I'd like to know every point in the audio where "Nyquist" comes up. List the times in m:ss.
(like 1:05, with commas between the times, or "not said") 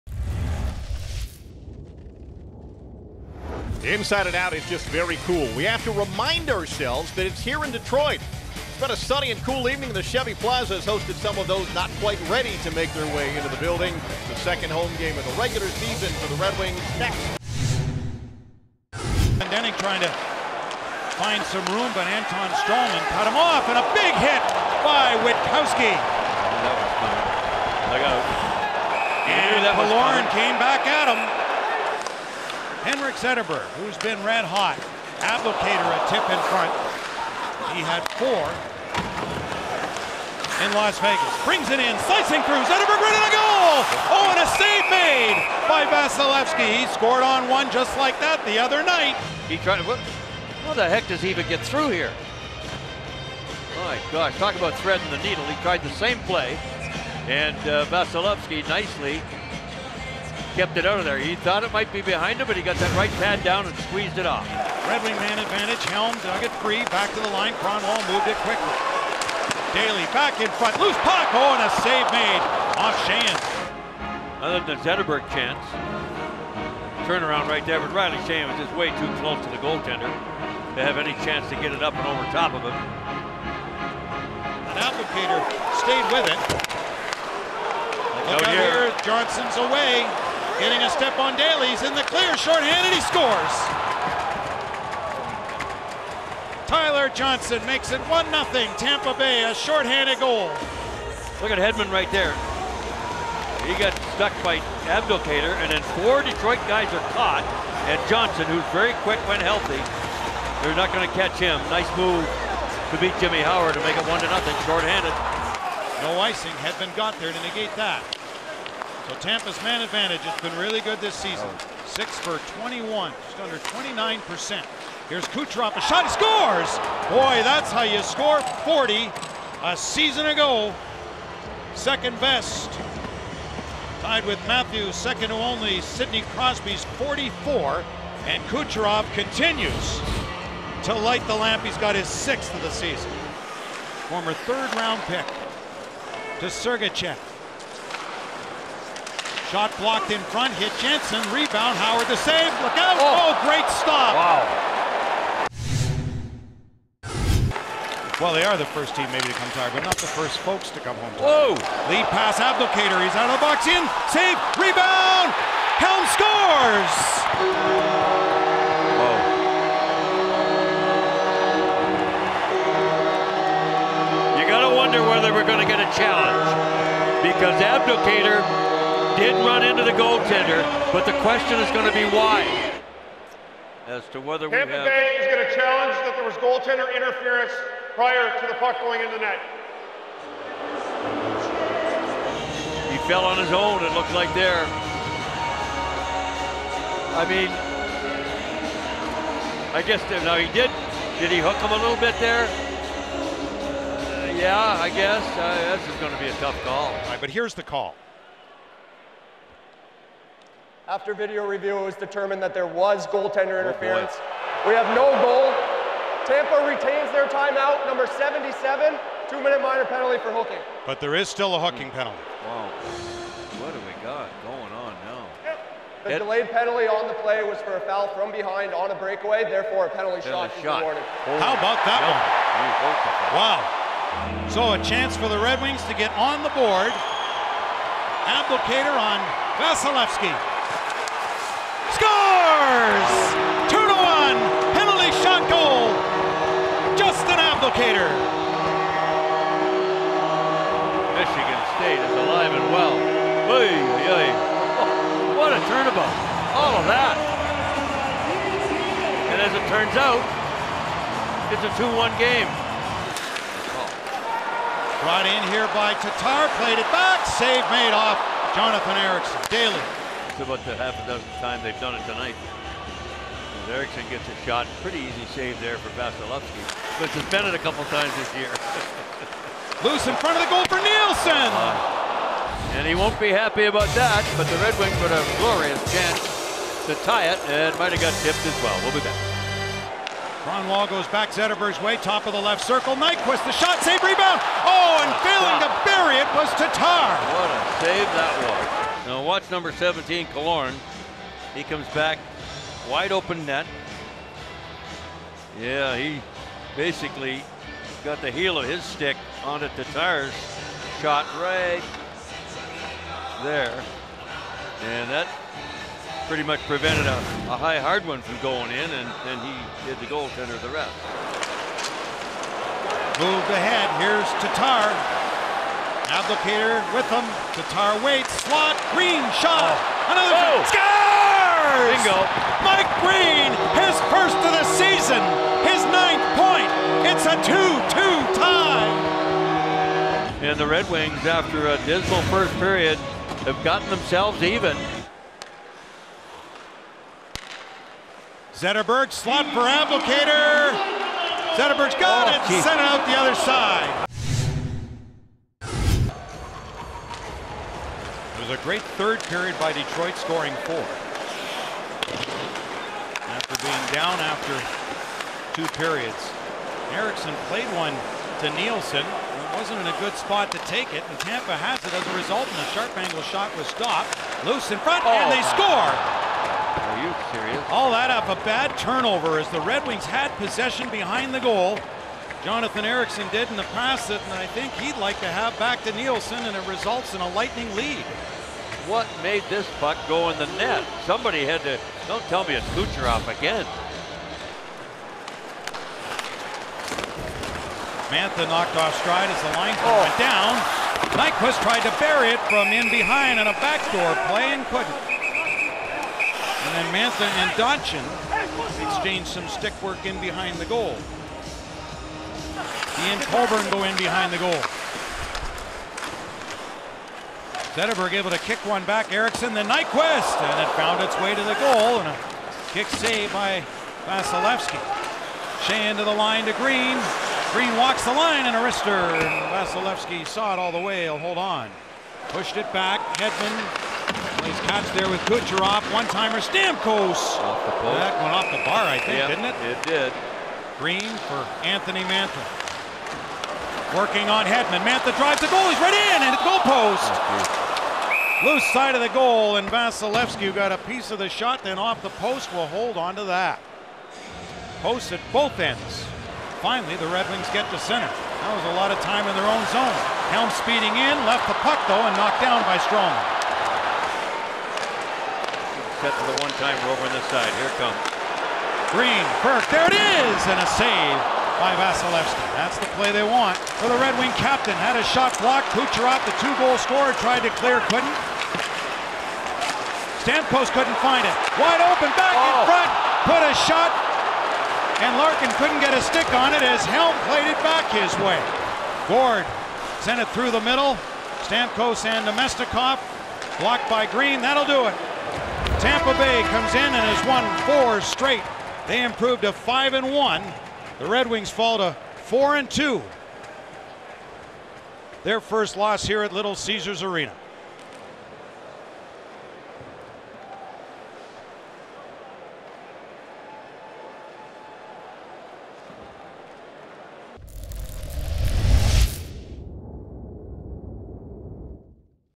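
4:52, 6:41, 6:59.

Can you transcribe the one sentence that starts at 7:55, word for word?
Kucherov, the two-goal scorer, tried to clear, couldn't.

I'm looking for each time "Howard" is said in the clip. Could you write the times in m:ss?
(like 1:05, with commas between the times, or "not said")
1:53, 2:31.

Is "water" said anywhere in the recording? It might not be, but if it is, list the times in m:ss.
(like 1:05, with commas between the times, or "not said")
not said.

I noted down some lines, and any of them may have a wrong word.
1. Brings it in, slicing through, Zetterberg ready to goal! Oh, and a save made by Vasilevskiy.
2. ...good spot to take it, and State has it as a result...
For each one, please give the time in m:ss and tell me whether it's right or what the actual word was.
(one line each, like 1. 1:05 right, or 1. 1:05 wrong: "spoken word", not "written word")
1. 0:41 right
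2. 6:09 wrong: "Tampa", not "State".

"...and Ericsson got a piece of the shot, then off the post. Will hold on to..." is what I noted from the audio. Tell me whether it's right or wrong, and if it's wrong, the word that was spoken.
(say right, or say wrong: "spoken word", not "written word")
wrong: "Vasilevskiy", not "Ericsson".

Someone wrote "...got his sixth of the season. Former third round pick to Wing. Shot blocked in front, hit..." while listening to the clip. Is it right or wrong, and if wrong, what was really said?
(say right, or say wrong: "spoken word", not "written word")
wrong: "Sergachev", not "Wing".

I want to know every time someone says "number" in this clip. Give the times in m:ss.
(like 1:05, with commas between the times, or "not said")
3:37, 4:59.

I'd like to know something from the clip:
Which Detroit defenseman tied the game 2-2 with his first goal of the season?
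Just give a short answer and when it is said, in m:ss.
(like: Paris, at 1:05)
Mike Green, at 5:32.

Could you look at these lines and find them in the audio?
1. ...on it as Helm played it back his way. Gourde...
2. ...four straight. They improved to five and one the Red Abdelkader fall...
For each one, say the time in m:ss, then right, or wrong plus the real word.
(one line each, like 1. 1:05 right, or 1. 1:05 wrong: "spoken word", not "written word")
1. 8:06 right
2. 8:17 wrong: "Wings", not "Abdelkader".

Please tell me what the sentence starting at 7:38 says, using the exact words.
That was a lot of time in their own zone.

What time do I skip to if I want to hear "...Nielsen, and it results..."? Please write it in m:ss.
6:25.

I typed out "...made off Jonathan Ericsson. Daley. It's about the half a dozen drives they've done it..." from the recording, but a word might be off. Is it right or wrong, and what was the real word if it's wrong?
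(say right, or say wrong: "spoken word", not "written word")
wrong: "times", not "drives".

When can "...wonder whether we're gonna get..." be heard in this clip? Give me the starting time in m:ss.
2:54.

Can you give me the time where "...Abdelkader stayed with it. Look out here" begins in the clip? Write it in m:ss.
1:24.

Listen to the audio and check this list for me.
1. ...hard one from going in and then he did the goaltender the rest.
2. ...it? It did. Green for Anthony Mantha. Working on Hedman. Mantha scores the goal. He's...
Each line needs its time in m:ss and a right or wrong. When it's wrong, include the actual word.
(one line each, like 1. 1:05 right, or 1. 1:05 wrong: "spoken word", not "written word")
1. 5:17 right
2. 7:19 wrong: "drives", not "scores".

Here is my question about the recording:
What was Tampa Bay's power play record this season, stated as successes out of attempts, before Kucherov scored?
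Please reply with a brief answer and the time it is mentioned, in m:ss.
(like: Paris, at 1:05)
6 for 21, at 2:01.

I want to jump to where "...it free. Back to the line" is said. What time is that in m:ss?
1:06.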